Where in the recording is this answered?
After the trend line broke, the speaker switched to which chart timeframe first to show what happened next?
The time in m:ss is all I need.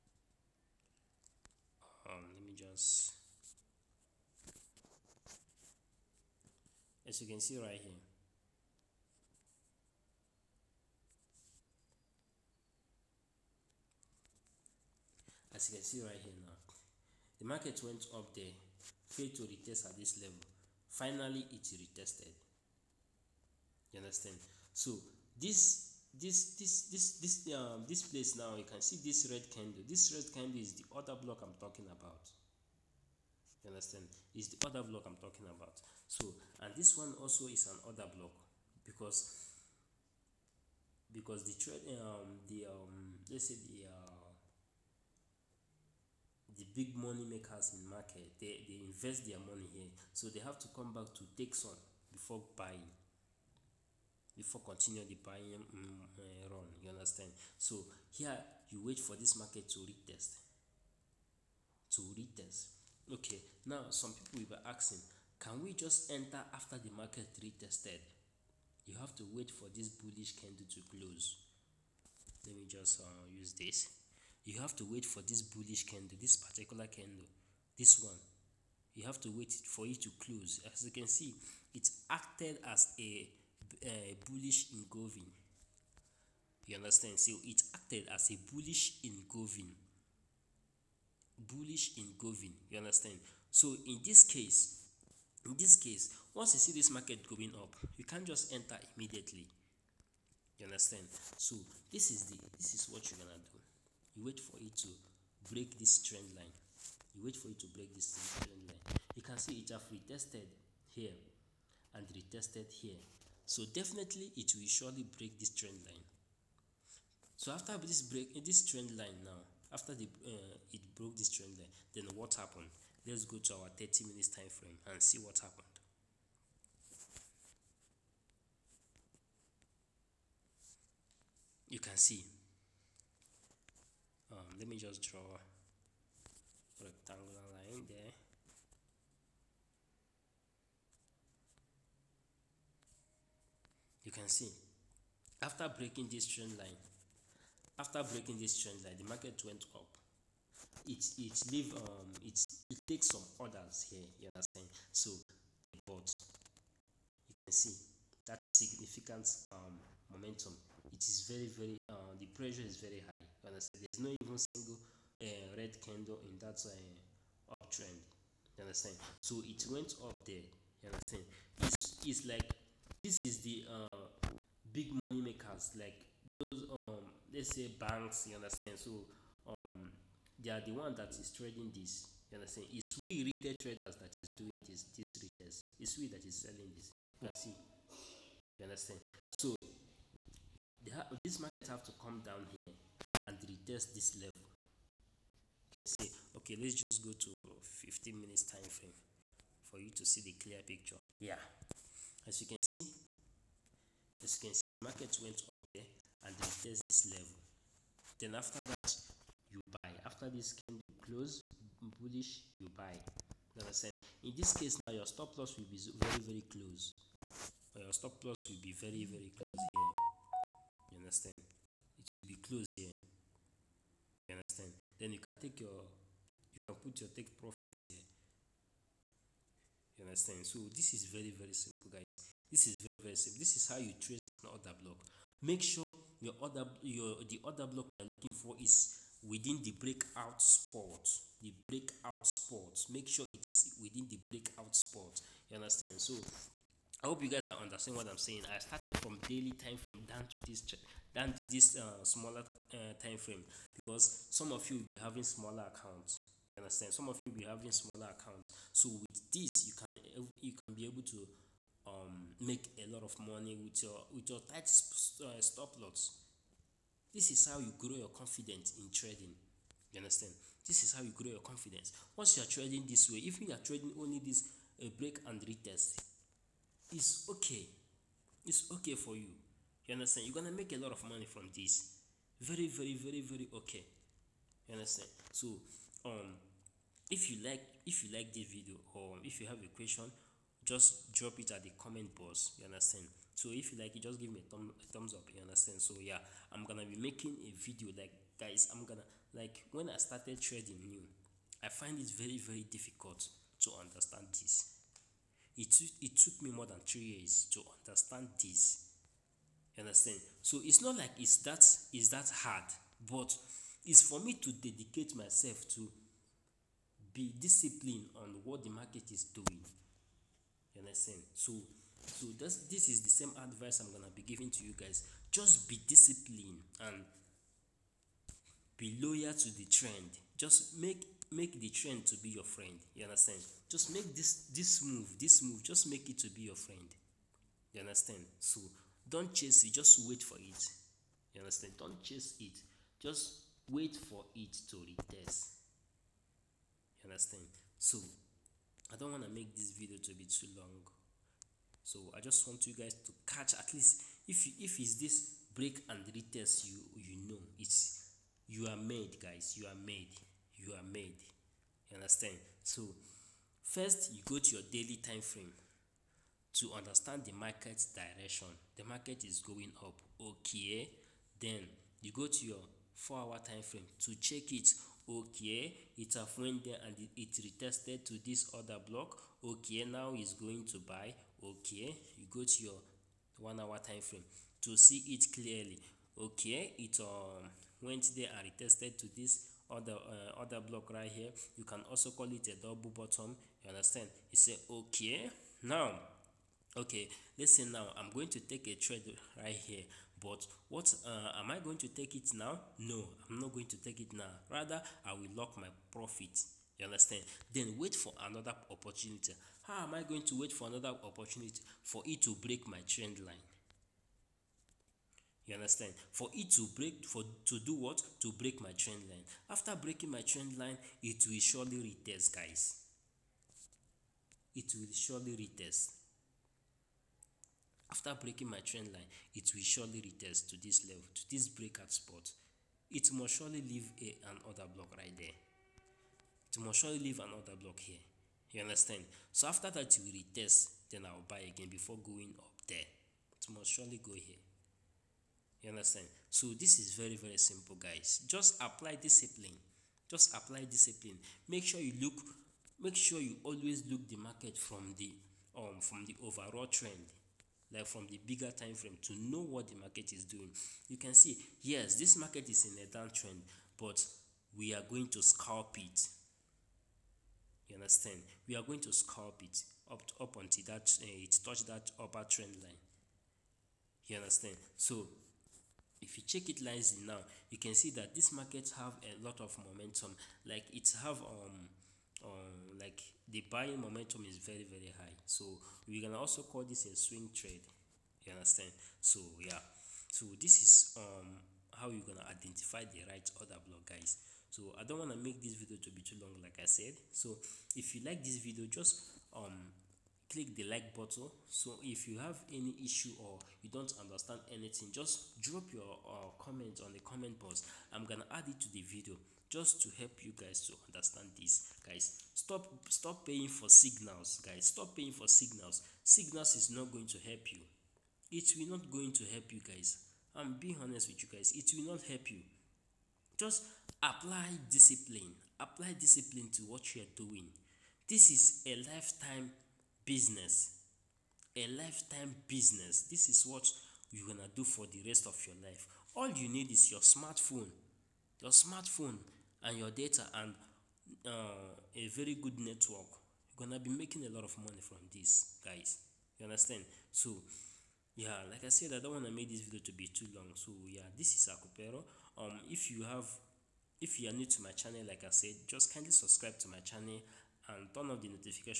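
2:03.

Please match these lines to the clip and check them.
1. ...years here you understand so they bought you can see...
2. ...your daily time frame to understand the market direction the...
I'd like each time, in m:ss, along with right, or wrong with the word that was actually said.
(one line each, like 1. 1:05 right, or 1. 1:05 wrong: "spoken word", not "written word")
1. 2:33 wrong: "orders", not "years"
2. 6:04 right.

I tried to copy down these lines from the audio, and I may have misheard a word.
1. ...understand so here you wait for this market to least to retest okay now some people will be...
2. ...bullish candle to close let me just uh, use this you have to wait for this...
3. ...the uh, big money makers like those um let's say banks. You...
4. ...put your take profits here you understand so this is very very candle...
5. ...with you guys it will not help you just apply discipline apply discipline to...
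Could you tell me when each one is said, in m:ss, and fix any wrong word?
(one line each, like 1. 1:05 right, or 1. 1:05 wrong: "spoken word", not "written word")
1. 0:56 wrong: "retest", not "least"
2. 1:09 right
3. 2:53 right
4. 3:46 wrong: "simple", not "candle"
5. 8:41 right.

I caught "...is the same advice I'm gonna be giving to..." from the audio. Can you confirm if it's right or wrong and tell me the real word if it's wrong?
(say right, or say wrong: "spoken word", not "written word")
right.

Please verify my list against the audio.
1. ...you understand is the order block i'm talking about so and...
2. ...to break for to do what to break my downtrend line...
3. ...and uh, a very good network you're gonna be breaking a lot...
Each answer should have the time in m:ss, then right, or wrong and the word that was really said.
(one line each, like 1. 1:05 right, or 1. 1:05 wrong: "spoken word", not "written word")
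1. 0:33 right
2. 6:56 wrong: "trend", not "downtrend"
3. 9:00 wrong: "making", not "breaking".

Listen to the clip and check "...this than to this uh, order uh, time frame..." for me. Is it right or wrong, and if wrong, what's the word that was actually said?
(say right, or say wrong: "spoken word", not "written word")
wrong: "smaller", not "order".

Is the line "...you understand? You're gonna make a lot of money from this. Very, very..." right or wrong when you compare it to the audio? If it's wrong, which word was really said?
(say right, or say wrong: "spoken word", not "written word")
right.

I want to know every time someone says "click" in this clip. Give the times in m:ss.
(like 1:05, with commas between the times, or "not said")
8:20.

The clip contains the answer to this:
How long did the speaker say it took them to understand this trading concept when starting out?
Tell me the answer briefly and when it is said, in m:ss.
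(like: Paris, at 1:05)
More than three years, at 5:06.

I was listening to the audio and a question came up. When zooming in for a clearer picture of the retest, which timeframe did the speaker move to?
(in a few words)
15 minutes.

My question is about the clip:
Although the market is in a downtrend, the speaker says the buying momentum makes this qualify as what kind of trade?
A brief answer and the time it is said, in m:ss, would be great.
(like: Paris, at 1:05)
Swing trade, at 8:06.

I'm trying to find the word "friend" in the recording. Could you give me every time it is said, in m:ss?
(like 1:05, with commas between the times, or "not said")
5:32, 5:36.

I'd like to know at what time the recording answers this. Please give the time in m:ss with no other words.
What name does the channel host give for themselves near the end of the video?
9:11.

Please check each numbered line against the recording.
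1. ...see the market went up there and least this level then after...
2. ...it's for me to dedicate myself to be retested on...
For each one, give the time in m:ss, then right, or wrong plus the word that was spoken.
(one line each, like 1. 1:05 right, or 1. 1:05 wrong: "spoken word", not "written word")
1. 3:24 wrong: "retest", not "least"
2. 5:13 wrong: "disciplined", not "retested".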